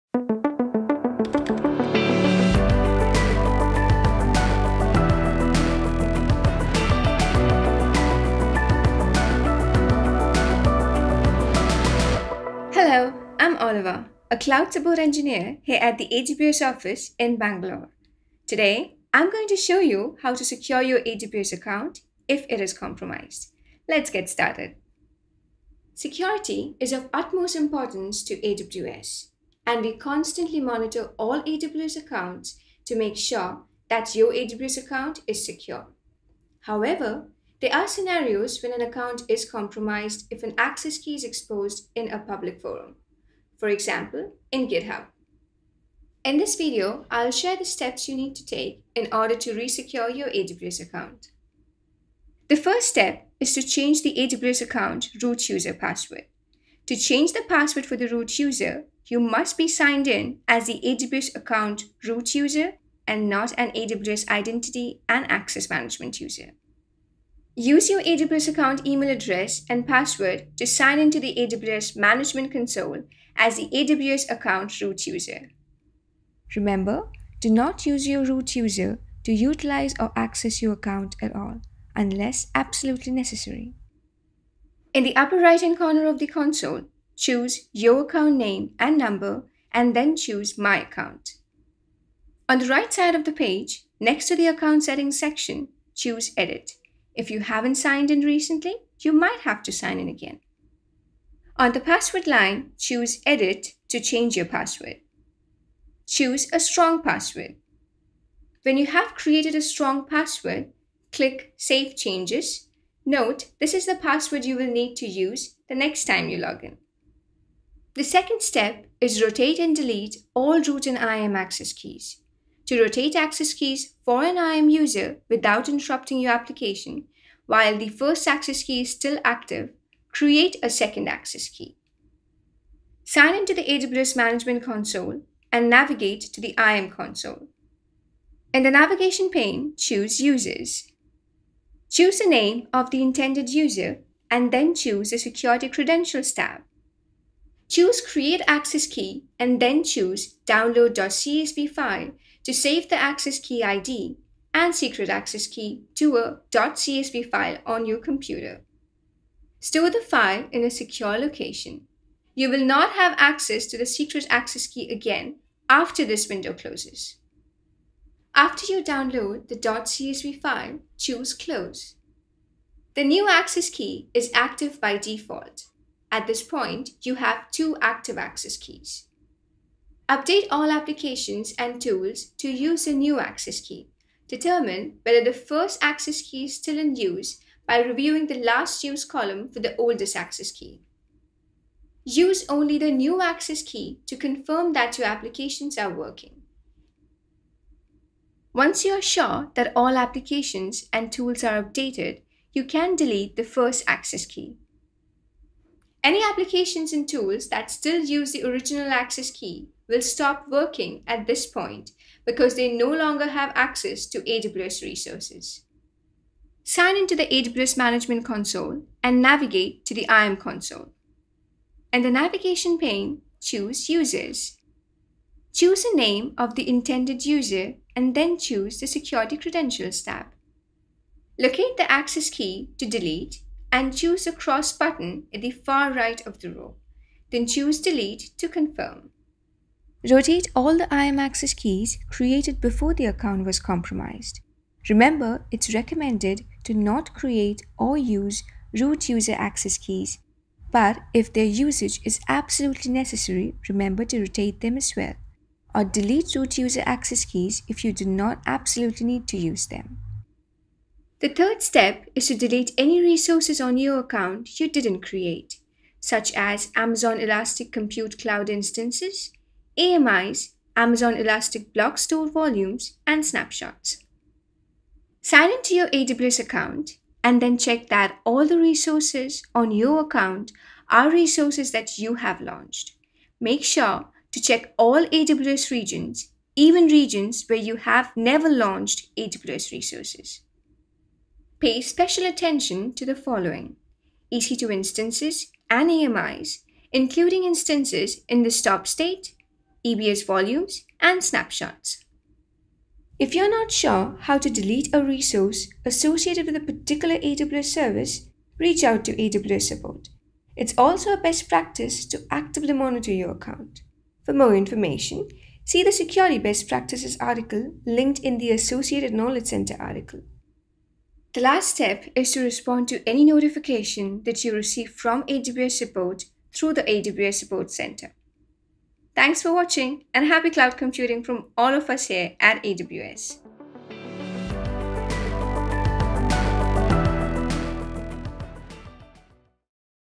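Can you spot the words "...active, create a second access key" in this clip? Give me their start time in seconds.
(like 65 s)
129 s.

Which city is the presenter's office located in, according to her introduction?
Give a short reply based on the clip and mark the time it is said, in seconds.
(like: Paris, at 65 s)
Bangalore, at 17 s.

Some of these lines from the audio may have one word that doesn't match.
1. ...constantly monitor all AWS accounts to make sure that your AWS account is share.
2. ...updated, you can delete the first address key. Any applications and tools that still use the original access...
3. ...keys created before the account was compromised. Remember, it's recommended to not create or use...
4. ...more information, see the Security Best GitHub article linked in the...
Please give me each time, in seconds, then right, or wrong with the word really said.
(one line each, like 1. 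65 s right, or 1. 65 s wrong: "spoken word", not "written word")
1. 29 s wrong: "secure", not "share"
2. 201 s wrong: "access", not "address"
3. 241 s right
4. 314 s wrong: "Practices", not "GitHub".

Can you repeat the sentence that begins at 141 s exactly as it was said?
Choose the name of the intended user and then choose the Security Credentials tab.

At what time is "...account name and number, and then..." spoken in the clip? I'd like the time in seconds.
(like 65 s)
88 s.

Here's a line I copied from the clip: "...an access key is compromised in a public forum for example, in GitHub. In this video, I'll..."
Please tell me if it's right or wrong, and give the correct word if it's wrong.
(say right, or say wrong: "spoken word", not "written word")
wrong: "exposed", not "compromised".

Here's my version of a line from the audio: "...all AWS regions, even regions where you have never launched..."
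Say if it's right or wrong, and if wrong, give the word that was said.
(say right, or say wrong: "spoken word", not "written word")
right.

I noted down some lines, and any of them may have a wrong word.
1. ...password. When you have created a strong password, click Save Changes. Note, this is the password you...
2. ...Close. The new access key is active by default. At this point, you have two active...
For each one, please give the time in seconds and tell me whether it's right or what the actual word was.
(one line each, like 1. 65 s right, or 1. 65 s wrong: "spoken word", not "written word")
1. 107 s right
2. 171 s right.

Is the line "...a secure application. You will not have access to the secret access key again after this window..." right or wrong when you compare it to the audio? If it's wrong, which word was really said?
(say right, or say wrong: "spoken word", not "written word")
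wrong: "location", not "application".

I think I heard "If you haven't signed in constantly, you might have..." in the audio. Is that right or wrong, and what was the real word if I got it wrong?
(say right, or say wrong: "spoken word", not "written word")
wrong: "recently", not "constantly".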